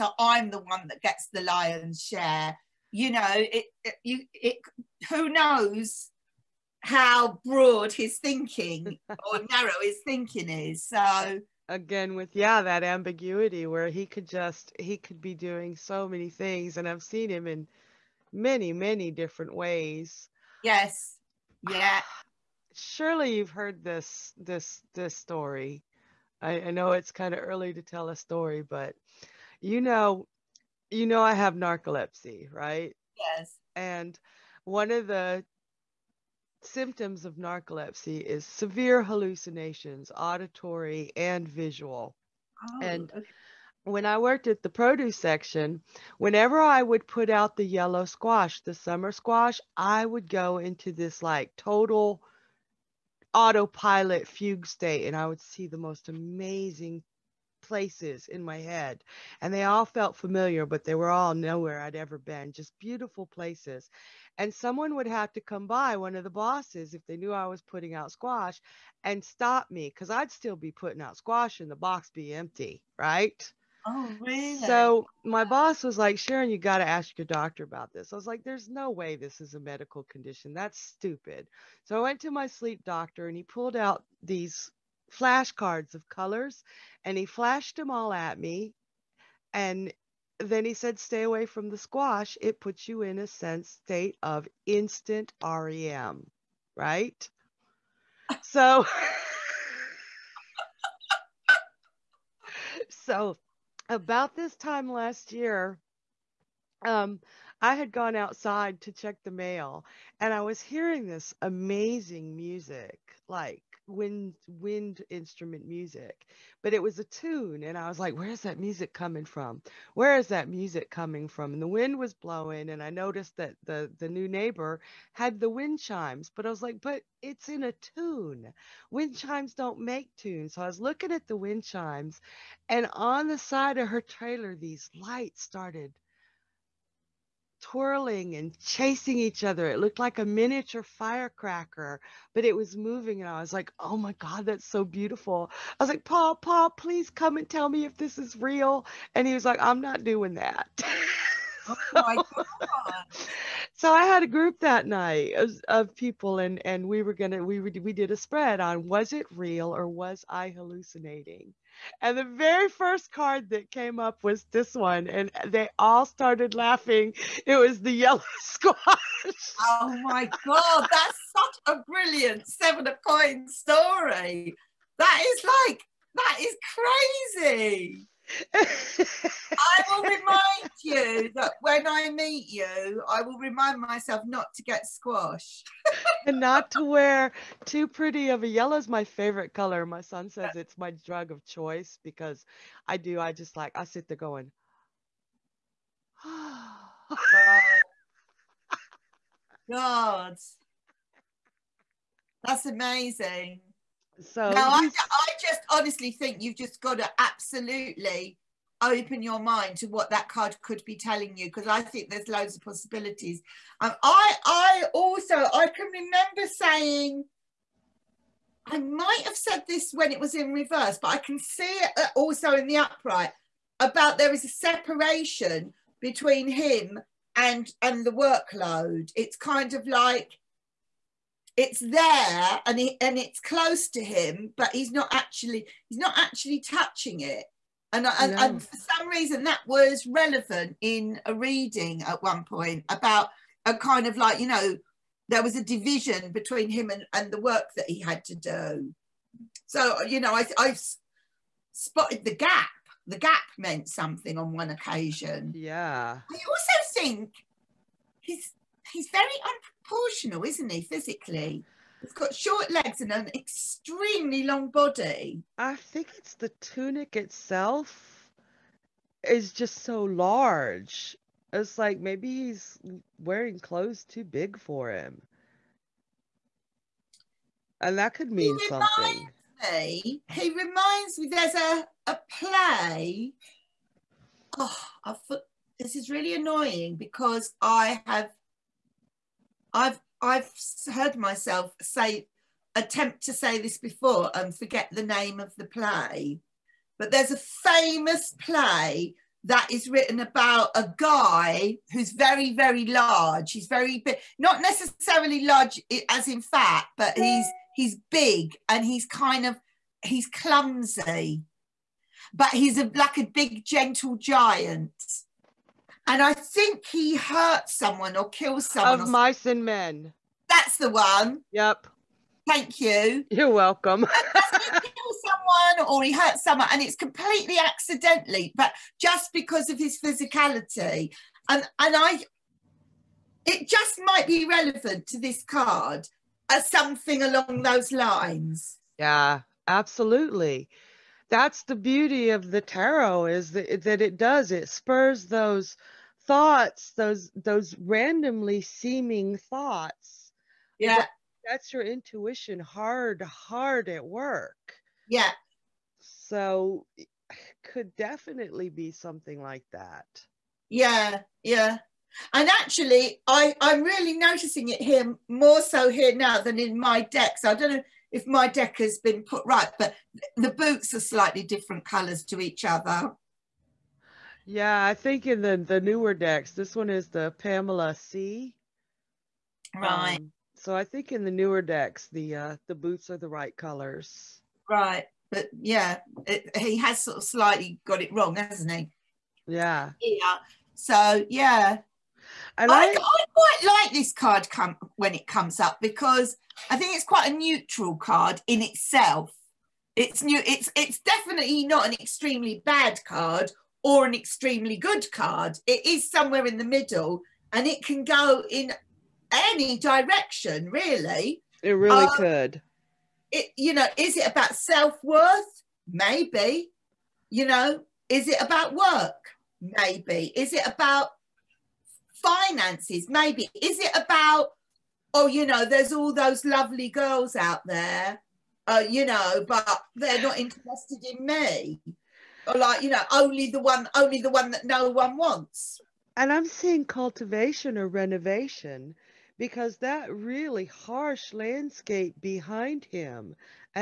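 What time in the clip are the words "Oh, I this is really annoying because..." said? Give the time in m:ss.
4:44.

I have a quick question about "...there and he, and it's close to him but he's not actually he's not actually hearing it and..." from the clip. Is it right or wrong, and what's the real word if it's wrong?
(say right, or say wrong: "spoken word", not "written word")
wrong: "touching", not "hearing".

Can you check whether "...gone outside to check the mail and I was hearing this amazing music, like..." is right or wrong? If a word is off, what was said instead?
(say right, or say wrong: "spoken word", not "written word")
right.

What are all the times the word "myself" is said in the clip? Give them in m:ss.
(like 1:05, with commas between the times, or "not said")
3:03, 4:51.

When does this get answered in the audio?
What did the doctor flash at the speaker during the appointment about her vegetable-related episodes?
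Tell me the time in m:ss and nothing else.
1:25.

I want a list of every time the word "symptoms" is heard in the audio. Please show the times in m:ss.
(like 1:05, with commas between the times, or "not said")
0:36.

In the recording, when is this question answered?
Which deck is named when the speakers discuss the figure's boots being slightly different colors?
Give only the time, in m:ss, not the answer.
6:17.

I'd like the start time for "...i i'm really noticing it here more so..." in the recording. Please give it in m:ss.
6:03.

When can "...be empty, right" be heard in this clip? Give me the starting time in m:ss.
1:12.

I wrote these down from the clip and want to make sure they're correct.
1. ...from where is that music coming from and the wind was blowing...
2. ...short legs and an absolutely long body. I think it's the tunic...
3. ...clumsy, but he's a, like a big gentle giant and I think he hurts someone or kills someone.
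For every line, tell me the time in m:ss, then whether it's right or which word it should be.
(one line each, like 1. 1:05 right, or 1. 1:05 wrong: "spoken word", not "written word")
1. 1:59 right
2. 4:22 wrong: "extremely", not "absolutely"
3. 5:10 right.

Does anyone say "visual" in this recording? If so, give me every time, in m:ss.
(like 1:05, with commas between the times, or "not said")
0:41.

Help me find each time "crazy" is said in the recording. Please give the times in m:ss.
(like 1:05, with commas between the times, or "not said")
2:57.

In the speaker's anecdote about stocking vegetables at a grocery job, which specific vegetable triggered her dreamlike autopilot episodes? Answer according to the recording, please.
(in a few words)
Yellow squash.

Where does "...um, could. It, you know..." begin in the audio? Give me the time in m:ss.
6:52.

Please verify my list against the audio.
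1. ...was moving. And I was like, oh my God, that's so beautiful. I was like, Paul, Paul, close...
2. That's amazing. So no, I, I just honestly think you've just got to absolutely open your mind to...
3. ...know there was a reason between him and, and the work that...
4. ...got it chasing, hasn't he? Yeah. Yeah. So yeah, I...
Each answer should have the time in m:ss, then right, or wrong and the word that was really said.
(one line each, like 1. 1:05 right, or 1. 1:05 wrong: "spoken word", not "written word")
1. 2:22 wrong: "please", not "close"
2. 3:22 right
3. 4:04 wrong: "division", not "reason"
4. 6:27 wrong: "wrong", not "chasing".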